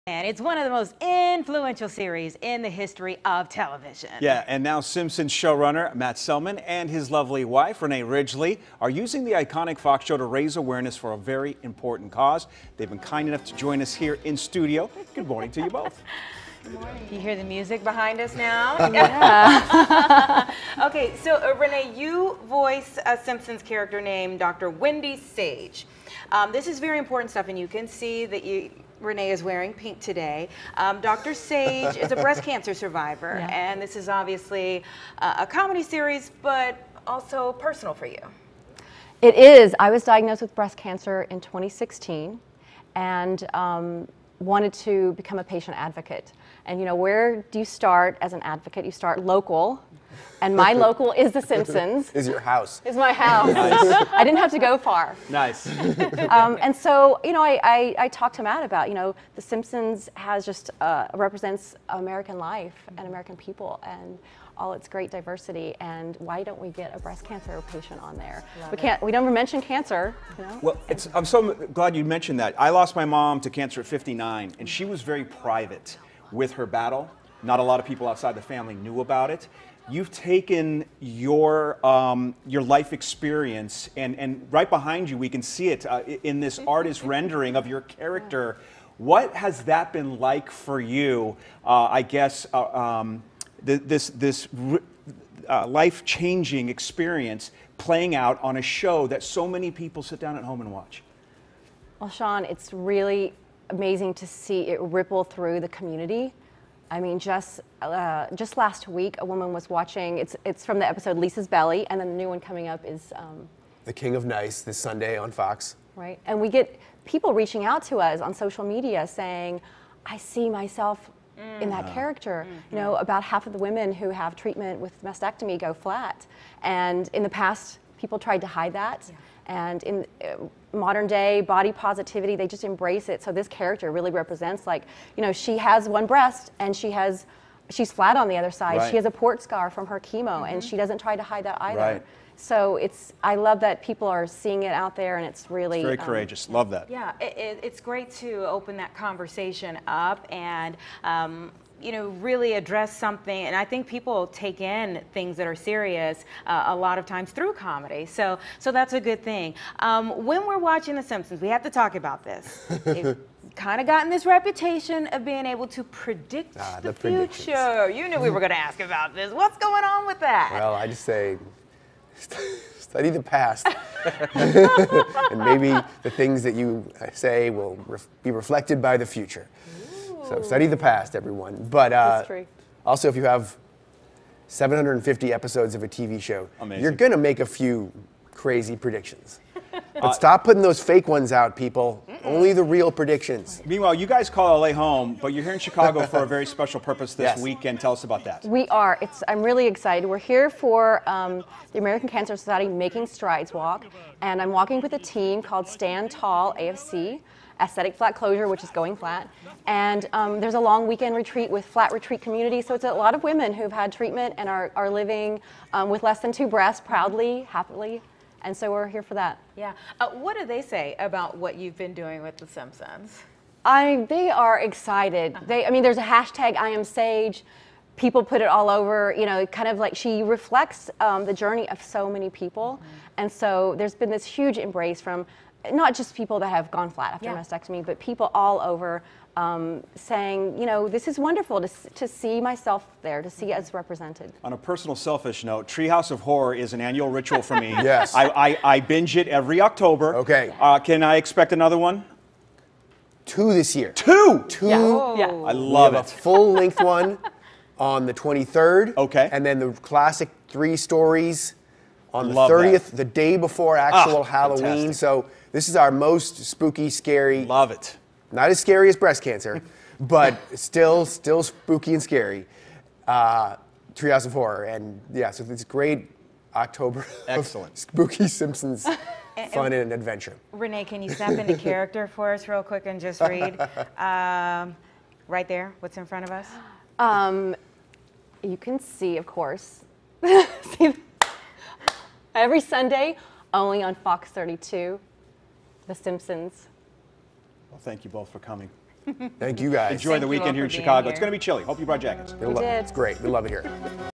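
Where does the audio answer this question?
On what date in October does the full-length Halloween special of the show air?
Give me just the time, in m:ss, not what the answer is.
4:18.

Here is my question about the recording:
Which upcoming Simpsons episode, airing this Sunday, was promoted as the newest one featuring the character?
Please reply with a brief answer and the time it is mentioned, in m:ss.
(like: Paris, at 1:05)
The King of Nice, at 1:53.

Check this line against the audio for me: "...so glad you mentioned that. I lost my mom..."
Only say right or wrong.
right.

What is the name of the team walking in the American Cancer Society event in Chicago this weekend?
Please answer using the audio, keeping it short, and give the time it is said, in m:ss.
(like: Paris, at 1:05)
Stand Tall AFC, at 3:25.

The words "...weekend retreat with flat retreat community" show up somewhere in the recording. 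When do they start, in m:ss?
3:30.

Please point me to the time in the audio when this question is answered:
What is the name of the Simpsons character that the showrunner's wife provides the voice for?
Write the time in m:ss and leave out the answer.
0:24.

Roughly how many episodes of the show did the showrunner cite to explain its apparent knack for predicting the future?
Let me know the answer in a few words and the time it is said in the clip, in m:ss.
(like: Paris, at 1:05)
750, at 3:04.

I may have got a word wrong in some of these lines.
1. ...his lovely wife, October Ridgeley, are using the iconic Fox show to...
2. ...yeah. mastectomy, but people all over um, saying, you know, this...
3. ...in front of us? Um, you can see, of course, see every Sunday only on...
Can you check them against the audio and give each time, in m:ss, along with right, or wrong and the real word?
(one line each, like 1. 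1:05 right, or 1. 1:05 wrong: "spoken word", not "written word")
1. 0:06 wrong: "Renee", not "October"
2. 3:57 right
3. 4:45 right.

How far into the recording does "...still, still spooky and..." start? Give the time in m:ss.
4:30.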